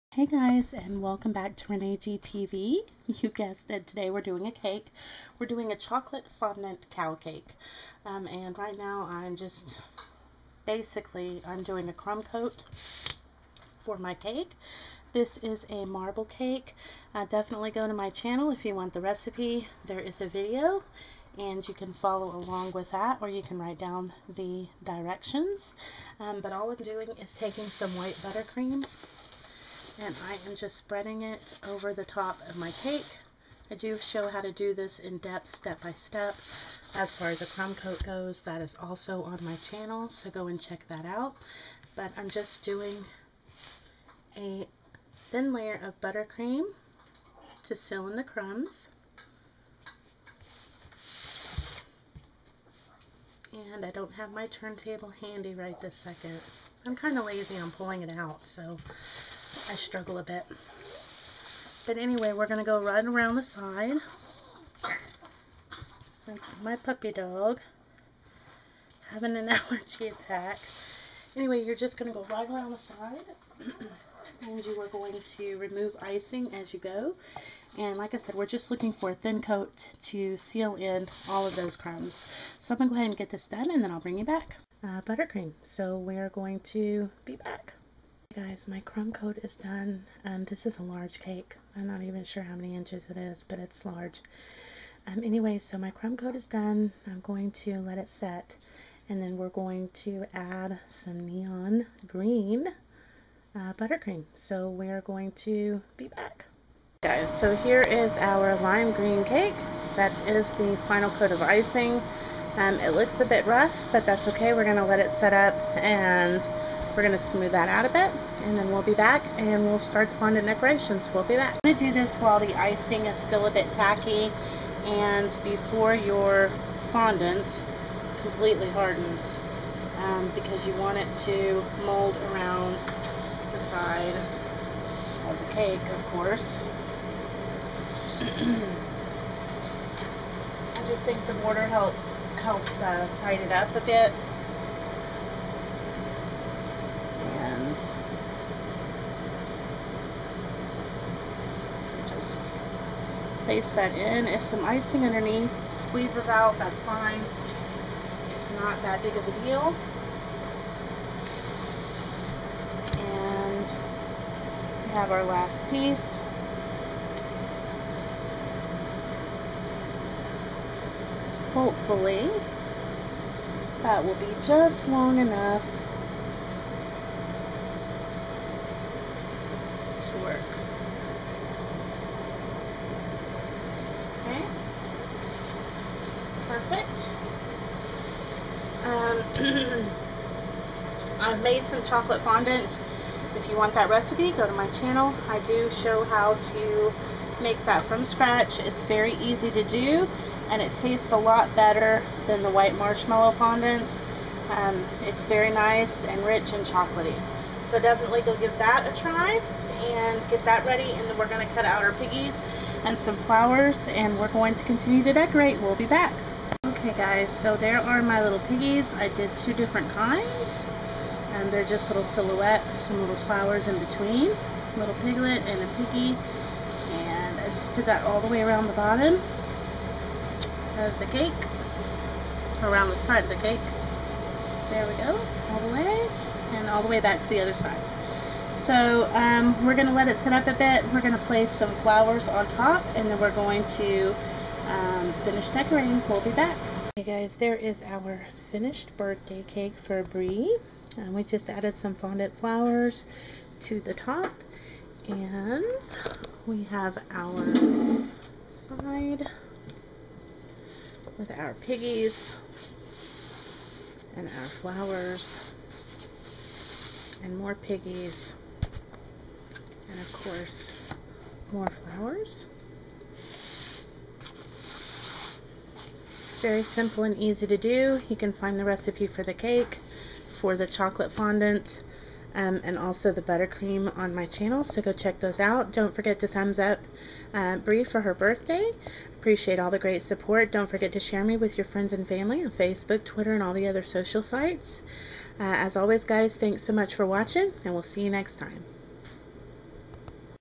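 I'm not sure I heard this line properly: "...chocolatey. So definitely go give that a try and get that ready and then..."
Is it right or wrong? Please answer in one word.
right.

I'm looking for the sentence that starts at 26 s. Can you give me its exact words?
Um, but all I'm doing is taking some white buttercream and I am just spreading it over the top of my cake.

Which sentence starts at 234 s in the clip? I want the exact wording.
There we go, all the way, and all the way back to the other side.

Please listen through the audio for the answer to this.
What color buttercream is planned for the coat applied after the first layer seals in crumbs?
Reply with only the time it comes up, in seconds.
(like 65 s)
101 s.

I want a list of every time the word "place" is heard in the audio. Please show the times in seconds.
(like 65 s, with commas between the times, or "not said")
153 s, 241 s.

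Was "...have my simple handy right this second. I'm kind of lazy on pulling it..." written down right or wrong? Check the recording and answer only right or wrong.
wrong.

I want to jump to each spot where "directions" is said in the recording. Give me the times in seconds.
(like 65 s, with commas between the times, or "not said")
24 s.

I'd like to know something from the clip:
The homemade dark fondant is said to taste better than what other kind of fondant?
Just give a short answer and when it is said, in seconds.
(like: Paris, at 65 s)
White marshmallow fondant, at 202 s.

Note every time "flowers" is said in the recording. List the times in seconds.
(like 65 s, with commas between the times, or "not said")
213 s, 223 s, 241 s, 252 s, 264 s, 271 s.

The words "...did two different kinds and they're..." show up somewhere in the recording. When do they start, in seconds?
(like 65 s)
219 s.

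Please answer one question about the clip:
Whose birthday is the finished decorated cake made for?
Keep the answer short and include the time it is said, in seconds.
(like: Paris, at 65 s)
Brie, at 250 s.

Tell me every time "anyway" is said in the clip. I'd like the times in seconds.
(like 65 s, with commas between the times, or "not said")
61 s, 71 s, 95 s.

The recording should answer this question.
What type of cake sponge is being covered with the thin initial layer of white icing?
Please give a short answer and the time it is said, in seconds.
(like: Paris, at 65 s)
Marble cake, at 15 s.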